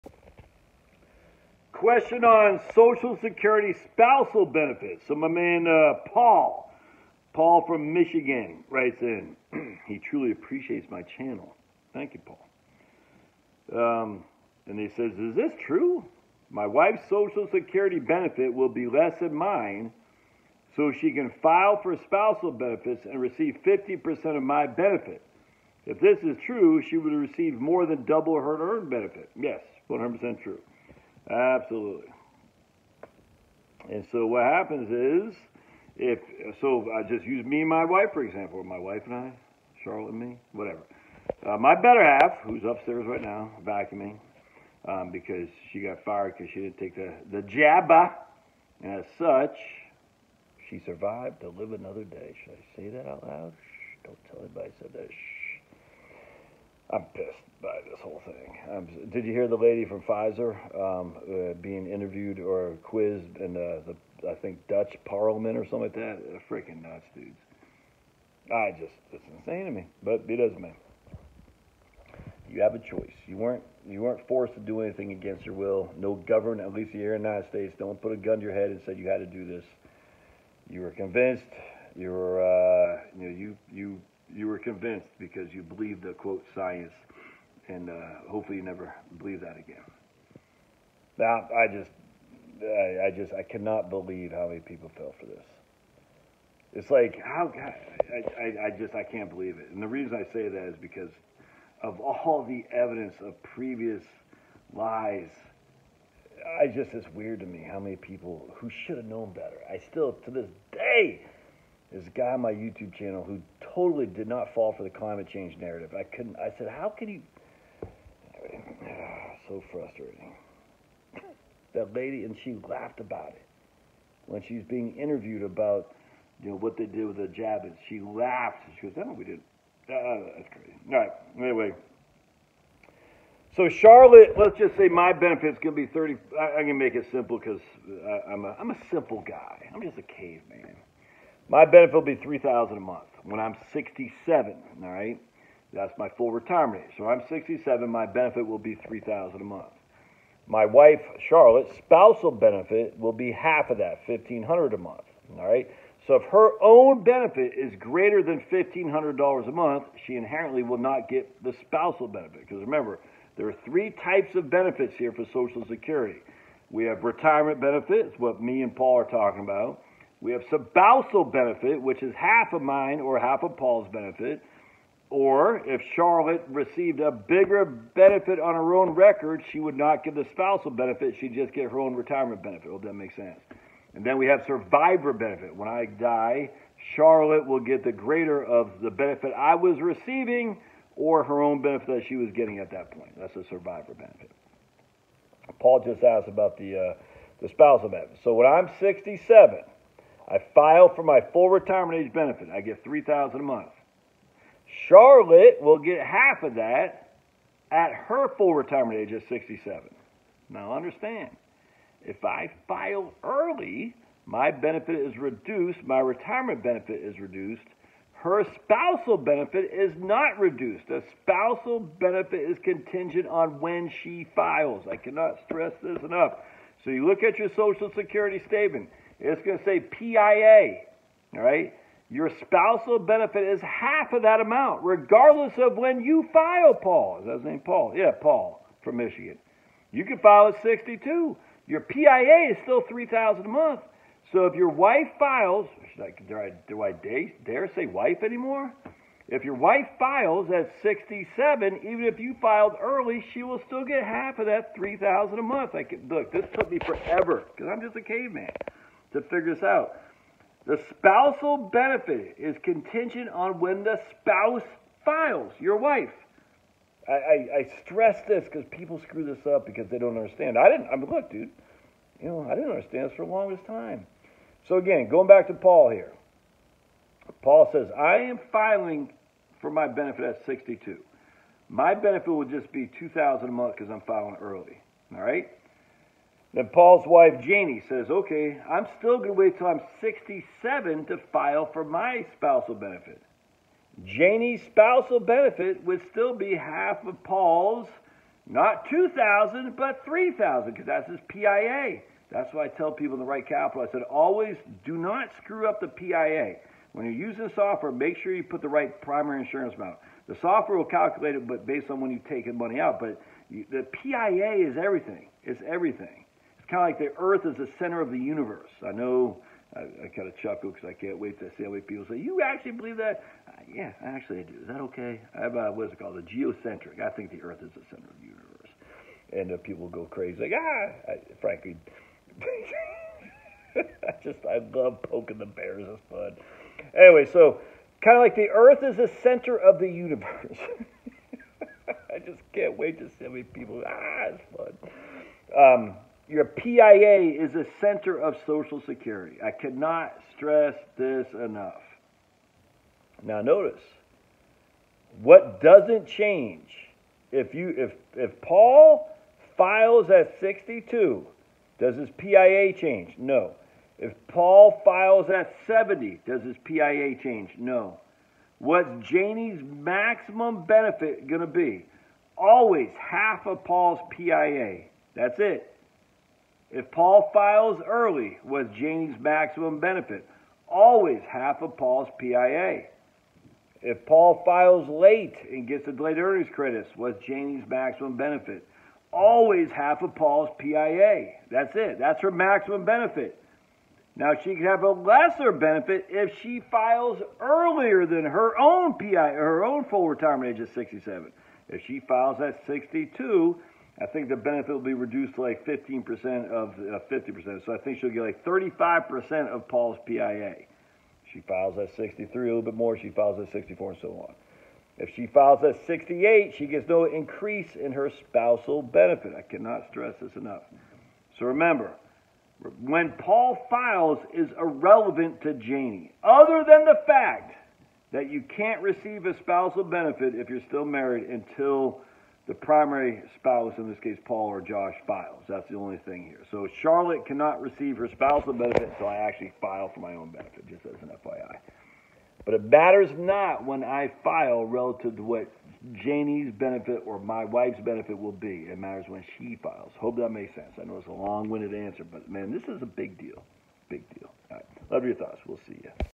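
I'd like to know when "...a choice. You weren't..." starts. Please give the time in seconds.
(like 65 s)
72 s.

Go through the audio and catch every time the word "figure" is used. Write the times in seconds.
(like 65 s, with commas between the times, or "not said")
259 s.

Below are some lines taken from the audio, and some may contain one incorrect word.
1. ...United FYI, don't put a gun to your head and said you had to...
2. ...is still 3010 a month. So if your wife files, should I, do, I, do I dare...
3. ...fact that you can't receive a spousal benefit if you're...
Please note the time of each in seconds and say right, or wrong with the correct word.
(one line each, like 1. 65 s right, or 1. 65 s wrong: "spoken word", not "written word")
1. 77 s wrong: "States", not "FYI"
2. 242 s wrong: "3000", not "3010"
3. 427 s right.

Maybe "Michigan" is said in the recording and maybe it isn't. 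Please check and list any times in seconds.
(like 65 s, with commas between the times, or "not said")
7 s, 238 s.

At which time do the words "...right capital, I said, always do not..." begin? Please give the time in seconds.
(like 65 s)
303 s.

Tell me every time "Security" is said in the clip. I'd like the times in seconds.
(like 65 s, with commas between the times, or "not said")
3 s, 17 s, 165 s, 227 s, 348 s.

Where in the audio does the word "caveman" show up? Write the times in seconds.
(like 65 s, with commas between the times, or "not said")
140 s, 258 s.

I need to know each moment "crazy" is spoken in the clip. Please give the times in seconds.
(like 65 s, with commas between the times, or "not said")
130 s, 330 s.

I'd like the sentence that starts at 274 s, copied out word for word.
So again, going back to Paul here.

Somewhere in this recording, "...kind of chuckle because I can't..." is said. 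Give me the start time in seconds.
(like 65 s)
320 s.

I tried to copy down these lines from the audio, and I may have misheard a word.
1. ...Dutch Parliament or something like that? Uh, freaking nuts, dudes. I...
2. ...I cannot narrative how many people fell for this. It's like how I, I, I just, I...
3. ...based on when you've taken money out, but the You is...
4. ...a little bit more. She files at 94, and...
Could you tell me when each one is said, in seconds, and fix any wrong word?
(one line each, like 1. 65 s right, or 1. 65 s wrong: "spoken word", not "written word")
1. 64 s right
2. 93 s wrong: "believe", not "narrative"
3. 311 s wrong: "PIA", not "You"
4. 412 s wrong: "64", not "94".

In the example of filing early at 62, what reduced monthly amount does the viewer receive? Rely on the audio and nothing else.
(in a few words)
$2,000.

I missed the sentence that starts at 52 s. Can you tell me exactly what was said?
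Should I say that out loud?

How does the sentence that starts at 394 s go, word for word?
Now she could have a lesser benefit if she files earlier than her own PIA, her own full retirement age of 67.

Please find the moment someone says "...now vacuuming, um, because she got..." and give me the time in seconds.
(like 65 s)
43 s.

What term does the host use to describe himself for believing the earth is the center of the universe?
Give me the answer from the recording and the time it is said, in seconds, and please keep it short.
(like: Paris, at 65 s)
geocentric, at 326 s.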